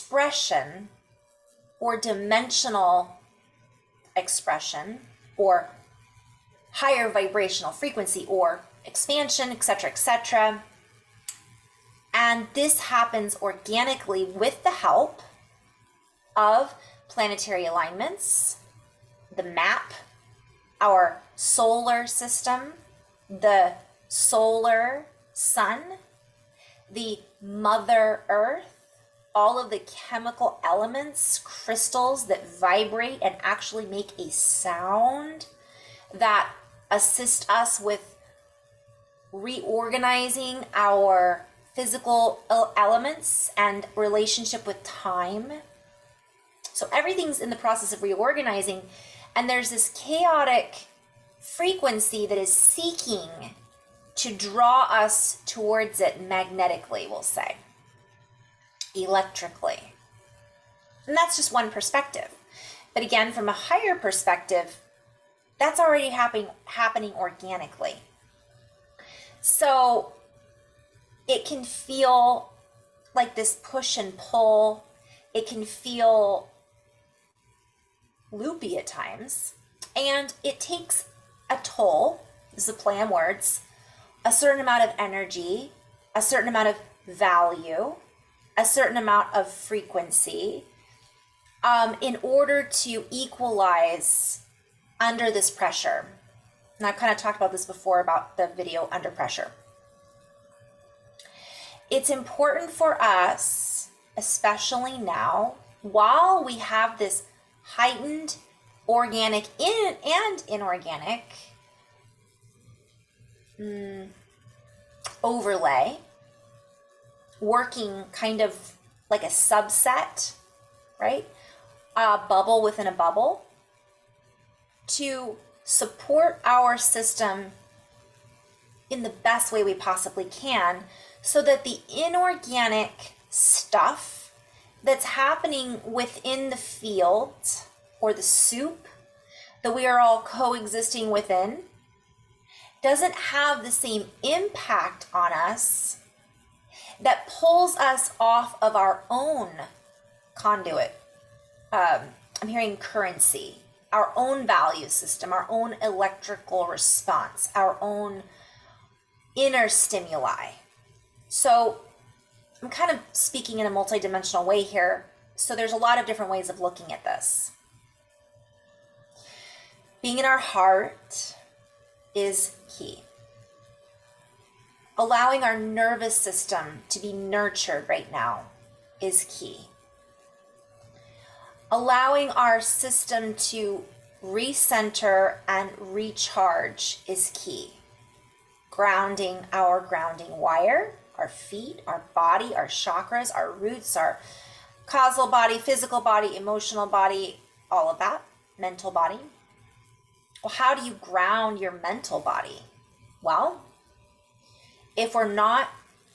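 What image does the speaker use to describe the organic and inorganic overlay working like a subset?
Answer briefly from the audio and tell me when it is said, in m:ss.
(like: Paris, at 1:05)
A bubble within a bubble, at 2:01.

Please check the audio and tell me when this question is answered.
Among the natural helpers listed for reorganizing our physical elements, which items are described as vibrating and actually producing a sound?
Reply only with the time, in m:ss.
0:31.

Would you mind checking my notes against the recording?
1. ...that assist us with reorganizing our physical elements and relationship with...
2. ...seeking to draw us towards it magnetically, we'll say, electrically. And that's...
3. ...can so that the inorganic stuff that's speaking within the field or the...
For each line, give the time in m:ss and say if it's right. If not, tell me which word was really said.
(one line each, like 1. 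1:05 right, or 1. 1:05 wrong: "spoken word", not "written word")
1. 0:36 right
2. 0:52 right
3. 2:10 wrong: "happening", not "speaking".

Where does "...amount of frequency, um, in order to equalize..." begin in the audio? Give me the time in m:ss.
1:28.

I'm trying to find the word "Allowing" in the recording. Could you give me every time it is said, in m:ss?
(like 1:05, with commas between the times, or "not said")
2:54, 3:01.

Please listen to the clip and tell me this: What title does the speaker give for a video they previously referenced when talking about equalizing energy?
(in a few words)
Under Pressure.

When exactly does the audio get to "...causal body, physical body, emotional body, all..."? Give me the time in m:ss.
3:14.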